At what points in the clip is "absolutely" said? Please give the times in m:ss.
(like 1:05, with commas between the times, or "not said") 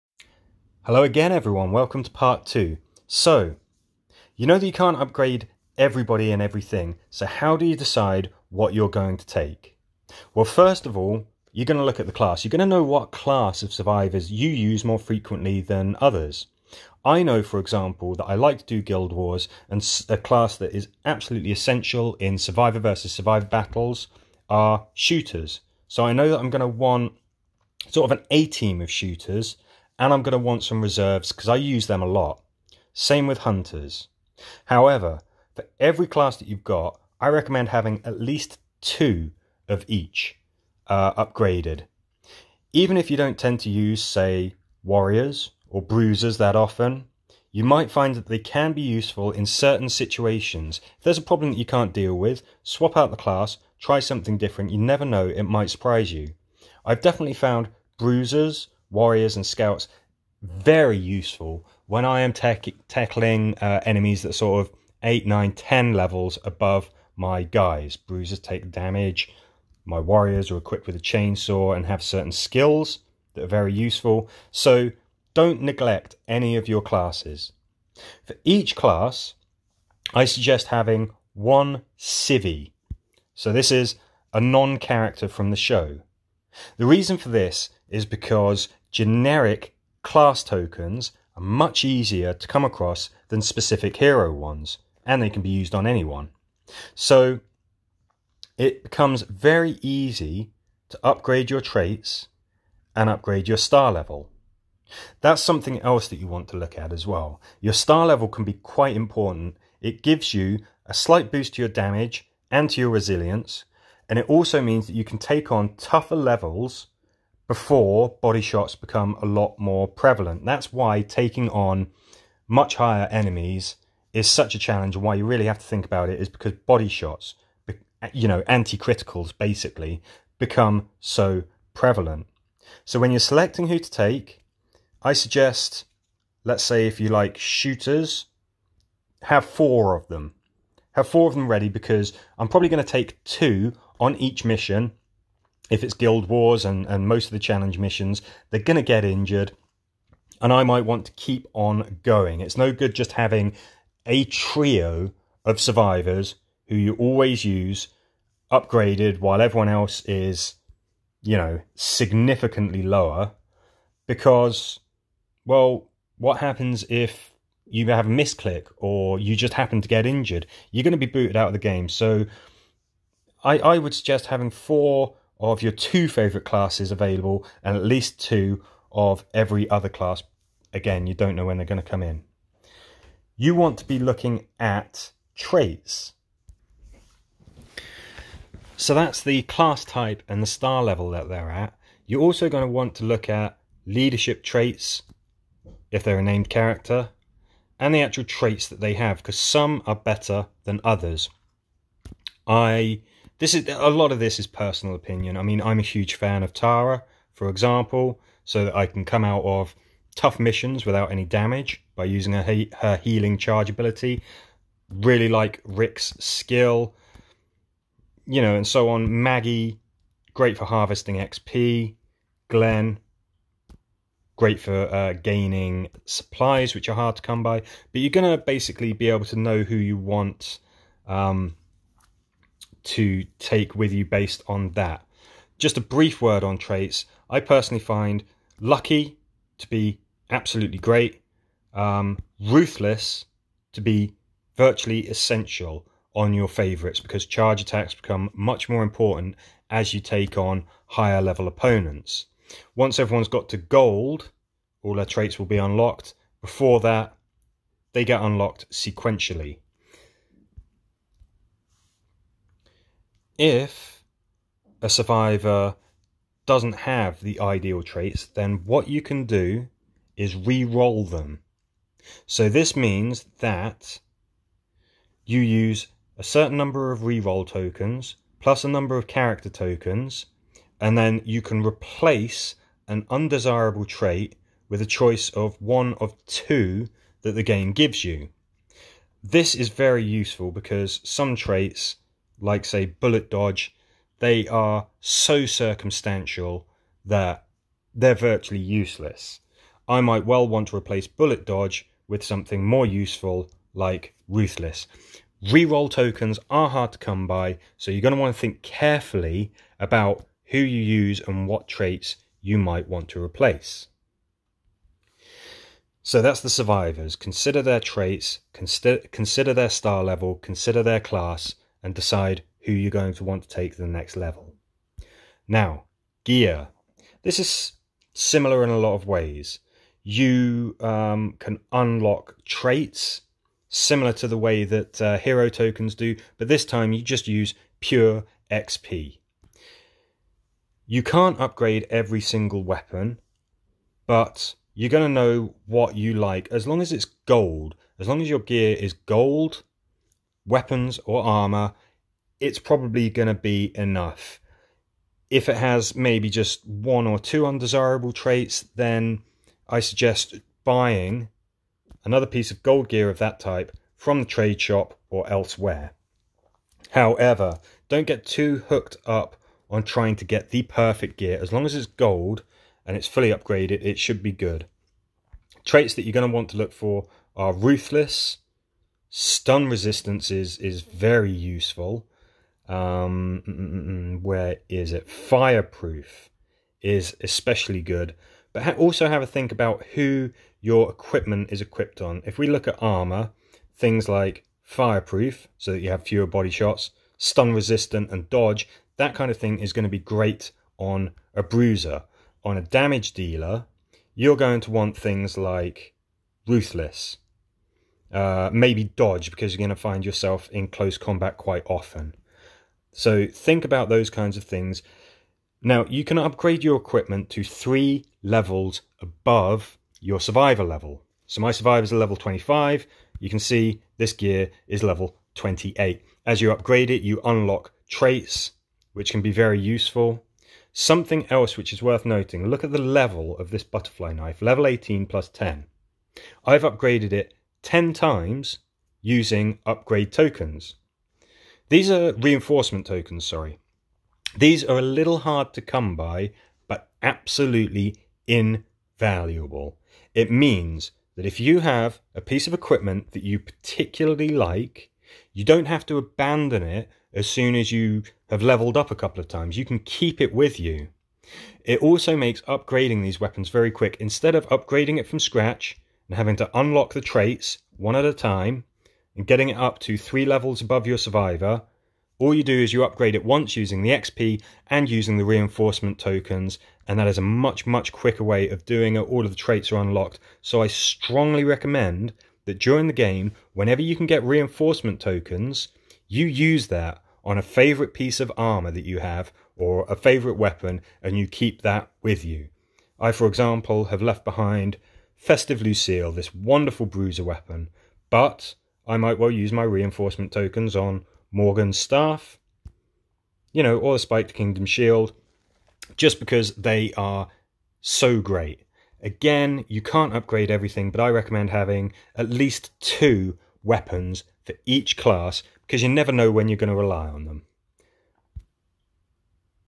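0:21, 4:00, 7:27.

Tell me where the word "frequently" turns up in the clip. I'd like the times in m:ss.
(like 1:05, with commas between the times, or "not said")
0:14.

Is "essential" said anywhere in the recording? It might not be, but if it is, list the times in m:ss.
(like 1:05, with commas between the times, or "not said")
0:21, 4:05.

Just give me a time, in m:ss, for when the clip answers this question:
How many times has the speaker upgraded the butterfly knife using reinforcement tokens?
7:17.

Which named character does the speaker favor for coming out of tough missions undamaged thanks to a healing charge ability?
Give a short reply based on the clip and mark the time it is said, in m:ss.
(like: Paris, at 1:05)
Tara, at 3:26.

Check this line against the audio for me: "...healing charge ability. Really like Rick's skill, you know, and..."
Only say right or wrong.
right.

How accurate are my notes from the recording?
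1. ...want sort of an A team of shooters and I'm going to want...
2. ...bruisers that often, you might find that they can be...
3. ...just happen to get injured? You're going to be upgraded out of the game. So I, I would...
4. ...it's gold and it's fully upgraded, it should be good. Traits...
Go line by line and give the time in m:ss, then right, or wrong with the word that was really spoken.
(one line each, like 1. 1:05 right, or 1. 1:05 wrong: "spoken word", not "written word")
1. 0:26 right
2. 0:45 right
3. 2:49 wrong: "booted", not "upgraded"
4. 6:11 right.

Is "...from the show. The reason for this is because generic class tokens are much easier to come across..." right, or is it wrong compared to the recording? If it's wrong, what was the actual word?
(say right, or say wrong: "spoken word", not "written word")
right.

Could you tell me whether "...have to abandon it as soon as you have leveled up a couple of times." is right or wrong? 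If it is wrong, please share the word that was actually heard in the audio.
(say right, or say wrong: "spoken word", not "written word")
right.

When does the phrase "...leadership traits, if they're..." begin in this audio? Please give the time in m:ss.
3:13.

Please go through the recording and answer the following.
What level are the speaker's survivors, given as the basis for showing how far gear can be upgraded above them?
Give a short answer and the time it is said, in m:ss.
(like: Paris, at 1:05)
25, at 7:01.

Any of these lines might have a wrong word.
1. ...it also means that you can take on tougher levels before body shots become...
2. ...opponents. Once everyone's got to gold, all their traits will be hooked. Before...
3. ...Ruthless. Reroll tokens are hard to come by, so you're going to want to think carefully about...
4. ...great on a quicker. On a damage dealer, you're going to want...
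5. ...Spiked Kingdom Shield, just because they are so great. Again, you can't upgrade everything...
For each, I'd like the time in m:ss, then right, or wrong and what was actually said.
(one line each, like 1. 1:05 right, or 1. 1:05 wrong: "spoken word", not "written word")
1. 1:54 right
2. 4:11 wrong: "unlocked", not "hooked"
3. 5:04 right
4. 6:39 wrong: "bruiser", not "quicker"
5. 8:23 right.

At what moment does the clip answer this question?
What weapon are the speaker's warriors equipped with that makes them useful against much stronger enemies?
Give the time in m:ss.
1:10.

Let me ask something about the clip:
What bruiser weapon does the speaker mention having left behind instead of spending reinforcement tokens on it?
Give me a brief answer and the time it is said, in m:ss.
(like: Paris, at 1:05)
Festive Lucille, at 8:15.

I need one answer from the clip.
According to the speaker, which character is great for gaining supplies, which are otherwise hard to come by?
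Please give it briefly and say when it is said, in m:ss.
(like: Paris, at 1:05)
Glenn, at 3:42.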